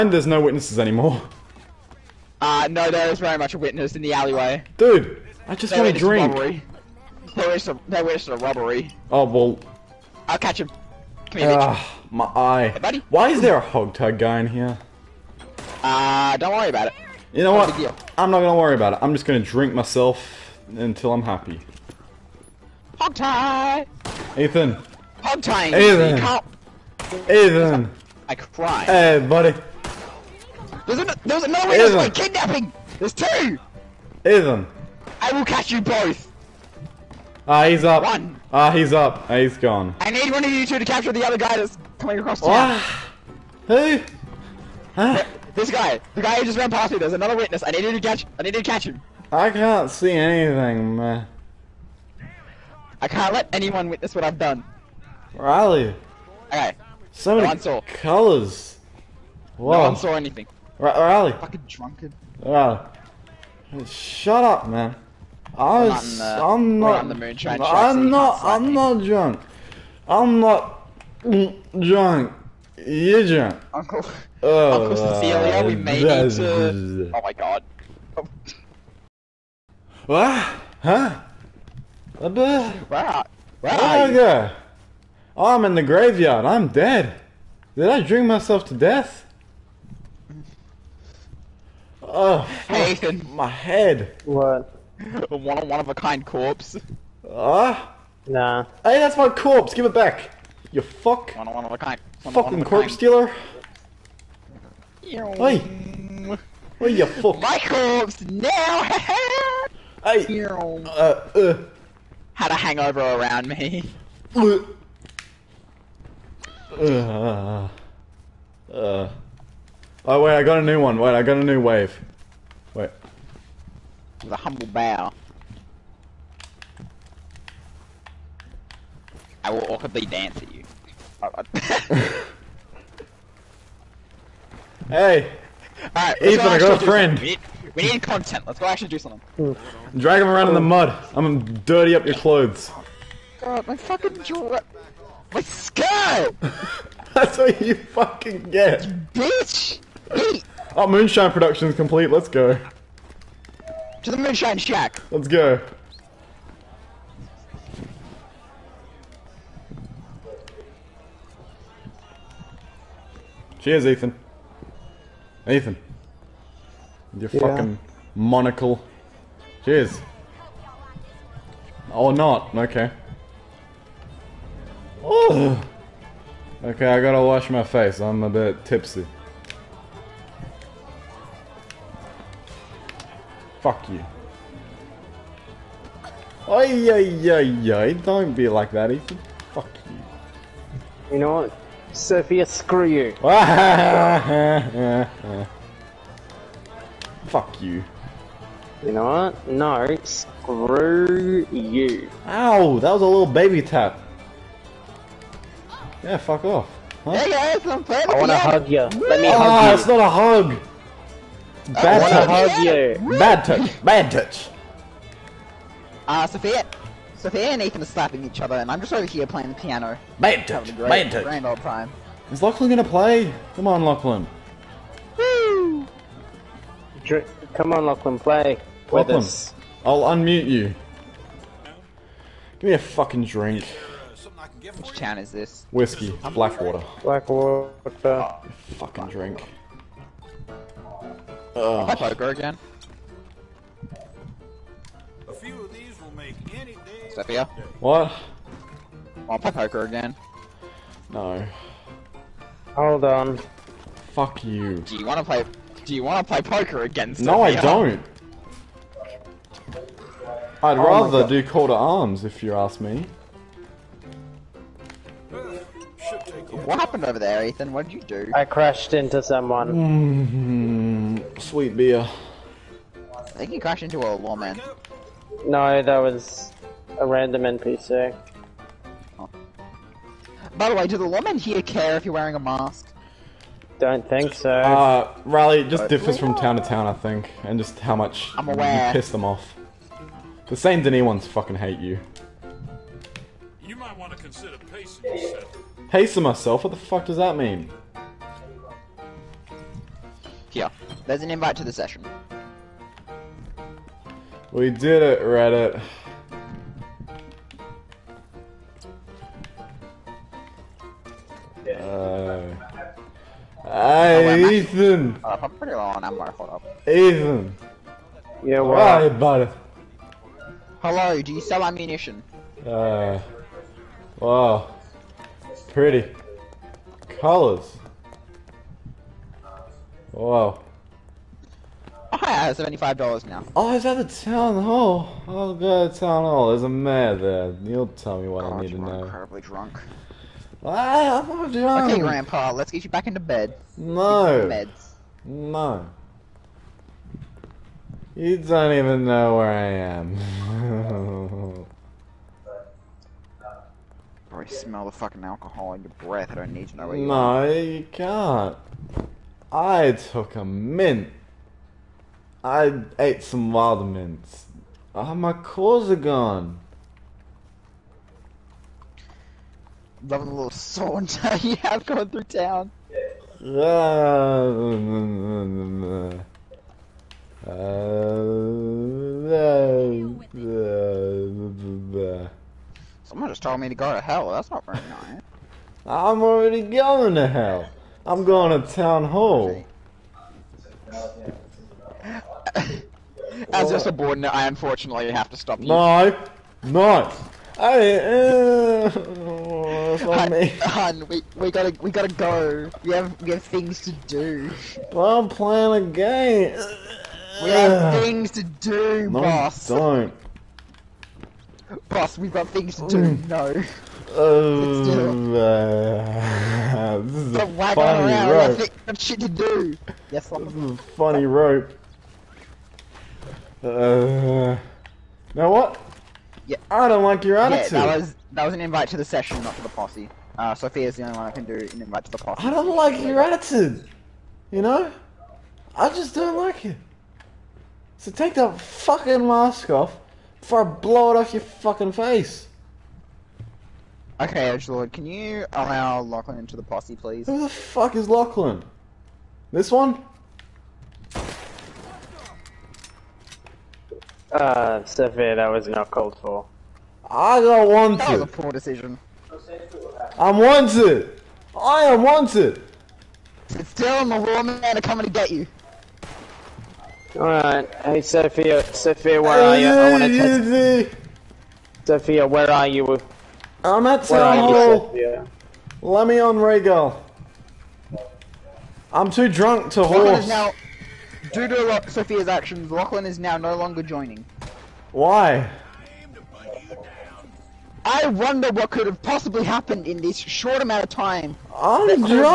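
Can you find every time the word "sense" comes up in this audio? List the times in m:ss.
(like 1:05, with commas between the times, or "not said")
not said.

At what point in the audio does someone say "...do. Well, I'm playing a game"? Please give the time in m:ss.
6:44.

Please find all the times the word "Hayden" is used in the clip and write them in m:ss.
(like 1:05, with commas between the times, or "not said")
1:32.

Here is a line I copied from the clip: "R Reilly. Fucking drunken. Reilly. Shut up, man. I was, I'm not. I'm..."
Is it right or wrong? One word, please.
right.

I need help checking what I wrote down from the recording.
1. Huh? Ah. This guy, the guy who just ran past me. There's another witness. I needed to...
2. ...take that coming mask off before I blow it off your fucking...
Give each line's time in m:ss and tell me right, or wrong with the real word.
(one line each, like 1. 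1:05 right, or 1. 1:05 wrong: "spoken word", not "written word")
1. 0:44 right
2. 7:18 wrong: "fucking", not "coming".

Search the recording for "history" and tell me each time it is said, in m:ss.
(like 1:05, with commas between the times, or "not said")
not said.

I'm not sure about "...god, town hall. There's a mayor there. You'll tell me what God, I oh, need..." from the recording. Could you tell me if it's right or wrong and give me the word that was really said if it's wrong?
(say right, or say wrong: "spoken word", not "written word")
right.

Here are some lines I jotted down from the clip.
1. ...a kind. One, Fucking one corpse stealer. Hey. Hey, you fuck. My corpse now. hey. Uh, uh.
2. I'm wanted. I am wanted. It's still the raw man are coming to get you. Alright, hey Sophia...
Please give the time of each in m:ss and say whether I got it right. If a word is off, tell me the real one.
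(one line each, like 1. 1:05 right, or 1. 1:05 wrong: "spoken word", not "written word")
1. 1:41 right
2. 7:40 right.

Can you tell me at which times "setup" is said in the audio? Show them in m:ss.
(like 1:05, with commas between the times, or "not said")
not said.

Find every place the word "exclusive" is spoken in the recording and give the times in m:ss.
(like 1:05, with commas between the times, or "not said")
not said.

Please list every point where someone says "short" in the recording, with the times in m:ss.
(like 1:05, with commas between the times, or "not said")
8:10.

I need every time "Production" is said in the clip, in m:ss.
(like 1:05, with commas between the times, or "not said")
2:31.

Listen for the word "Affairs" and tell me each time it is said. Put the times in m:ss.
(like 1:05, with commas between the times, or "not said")
not said.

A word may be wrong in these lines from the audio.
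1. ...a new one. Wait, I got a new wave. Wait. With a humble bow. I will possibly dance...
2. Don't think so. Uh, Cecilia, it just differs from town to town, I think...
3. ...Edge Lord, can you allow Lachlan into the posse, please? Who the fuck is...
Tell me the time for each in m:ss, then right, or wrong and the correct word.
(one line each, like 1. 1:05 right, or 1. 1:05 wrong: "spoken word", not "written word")
1. 2:00 wrong: "awkwardly", not "possibly"
2. 4:43 wrong: "Reilly", not "Cecilia"
3. 7:24 right.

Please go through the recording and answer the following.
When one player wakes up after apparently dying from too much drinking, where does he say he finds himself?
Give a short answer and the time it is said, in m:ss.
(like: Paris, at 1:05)
Graveyard, at 1:25.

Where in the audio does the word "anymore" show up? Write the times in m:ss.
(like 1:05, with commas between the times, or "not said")
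0:00.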